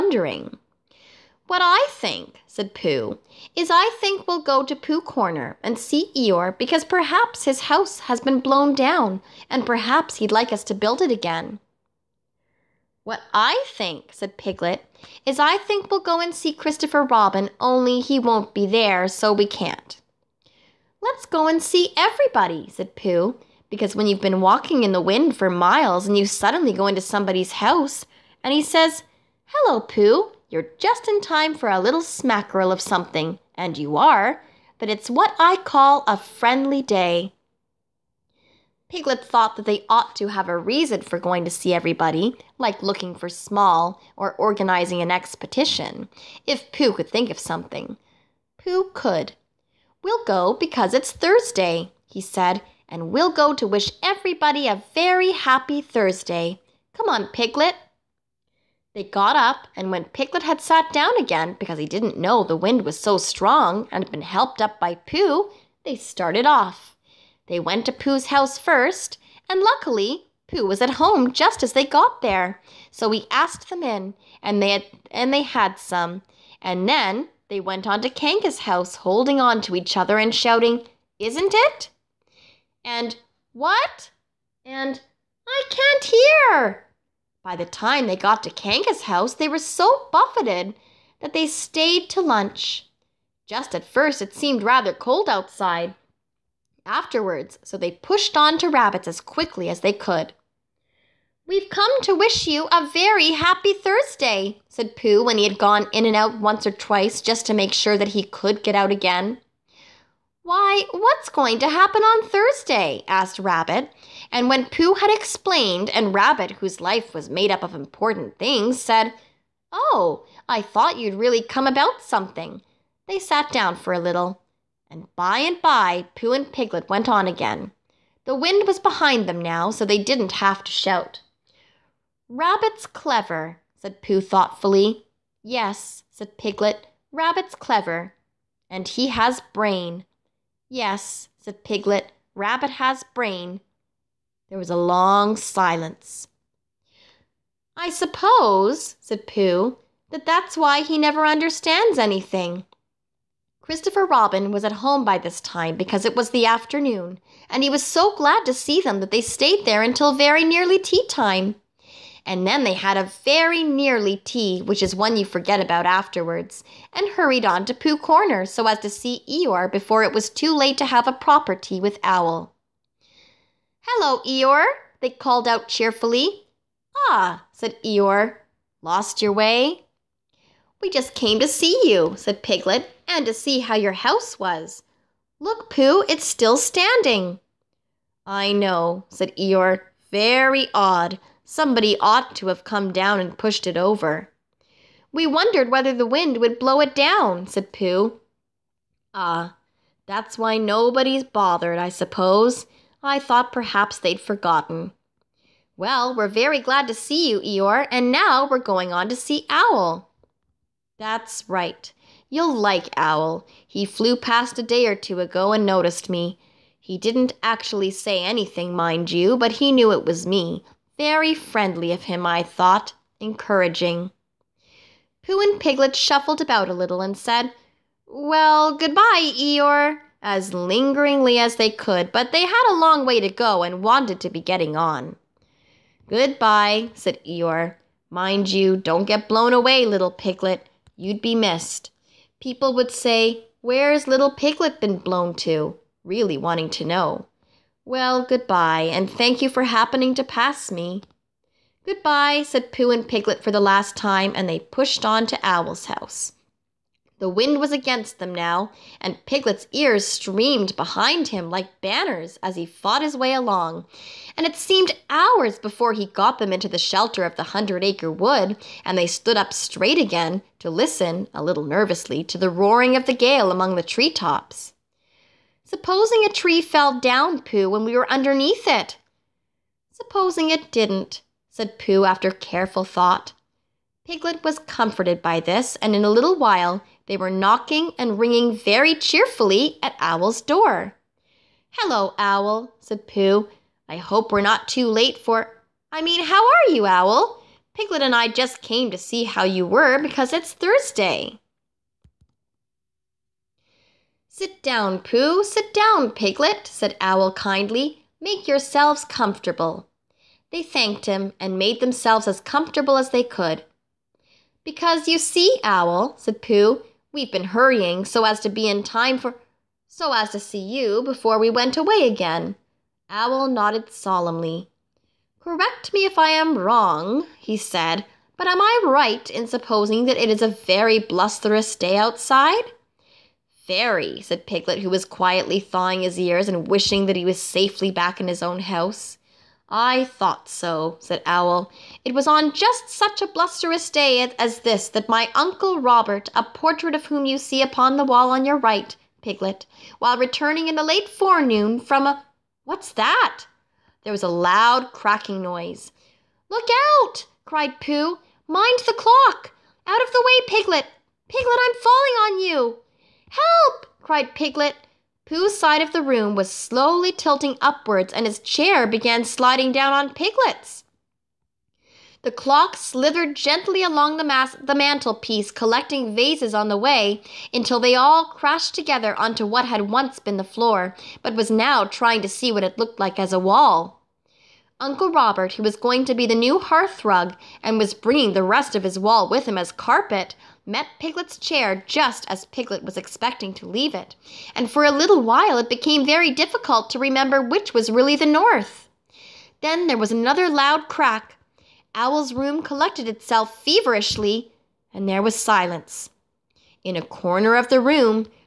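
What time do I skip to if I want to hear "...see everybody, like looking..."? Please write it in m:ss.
0:41.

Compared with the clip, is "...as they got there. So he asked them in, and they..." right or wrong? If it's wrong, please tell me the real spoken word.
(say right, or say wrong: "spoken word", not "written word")
right.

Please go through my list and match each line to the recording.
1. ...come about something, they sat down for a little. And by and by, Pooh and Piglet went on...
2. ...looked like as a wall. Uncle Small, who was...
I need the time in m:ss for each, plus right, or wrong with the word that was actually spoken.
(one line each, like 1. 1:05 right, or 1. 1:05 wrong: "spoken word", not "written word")
1. 2:01 right
2. 6:22 wrong: "Robert", not "Small".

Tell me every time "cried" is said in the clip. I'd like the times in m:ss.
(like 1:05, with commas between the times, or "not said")
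5:57, 6:04.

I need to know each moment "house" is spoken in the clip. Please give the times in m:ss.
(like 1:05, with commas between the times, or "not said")
0:07, 0:27, 1:08, 1:18, 1:29, 3:03, 4:15, 5:38.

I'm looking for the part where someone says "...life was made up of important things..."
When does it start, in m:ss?
1:56.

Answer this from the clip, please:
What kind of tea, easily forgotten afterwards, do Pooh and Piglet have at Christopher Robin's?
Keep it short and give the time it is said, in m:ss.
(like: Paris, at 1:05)
a very nearly tea, at 2:42.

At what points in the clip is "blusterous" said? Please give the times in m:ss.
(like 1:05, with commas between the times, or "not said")
5:30, 5:43.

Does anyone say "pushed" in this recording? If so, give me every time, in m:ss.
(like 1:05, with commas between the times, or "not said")
1:37, 3:13, 4:14.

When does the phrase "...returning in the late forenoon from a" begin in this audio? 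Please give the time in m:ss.
5:50.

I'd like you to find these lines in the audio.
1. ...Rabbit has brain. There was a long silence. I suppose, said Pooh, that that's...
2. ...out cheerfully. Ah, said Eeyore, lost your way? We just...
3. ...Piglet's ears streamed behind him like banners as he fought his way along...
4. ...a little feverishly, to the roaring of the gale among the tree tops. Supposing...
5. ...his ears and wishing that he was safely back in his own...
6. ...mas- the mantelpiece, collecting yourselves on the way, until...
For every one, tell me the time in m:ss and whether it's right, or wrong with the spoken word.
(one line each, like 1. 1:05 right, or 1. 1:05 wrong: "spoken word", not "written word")
1. 2:22 right
2. 2:55 right
3. 4:19 right
4. 4:31 wrong: "nervously", not "feverishly"
5. 5:36 right
6. 6:14 wrong: "vases", not "yourselves".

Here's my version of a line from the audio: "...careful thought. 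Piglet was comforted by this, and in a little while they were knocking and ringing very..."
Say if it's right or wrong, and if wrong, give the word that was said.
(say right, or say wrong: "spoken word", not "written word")
right.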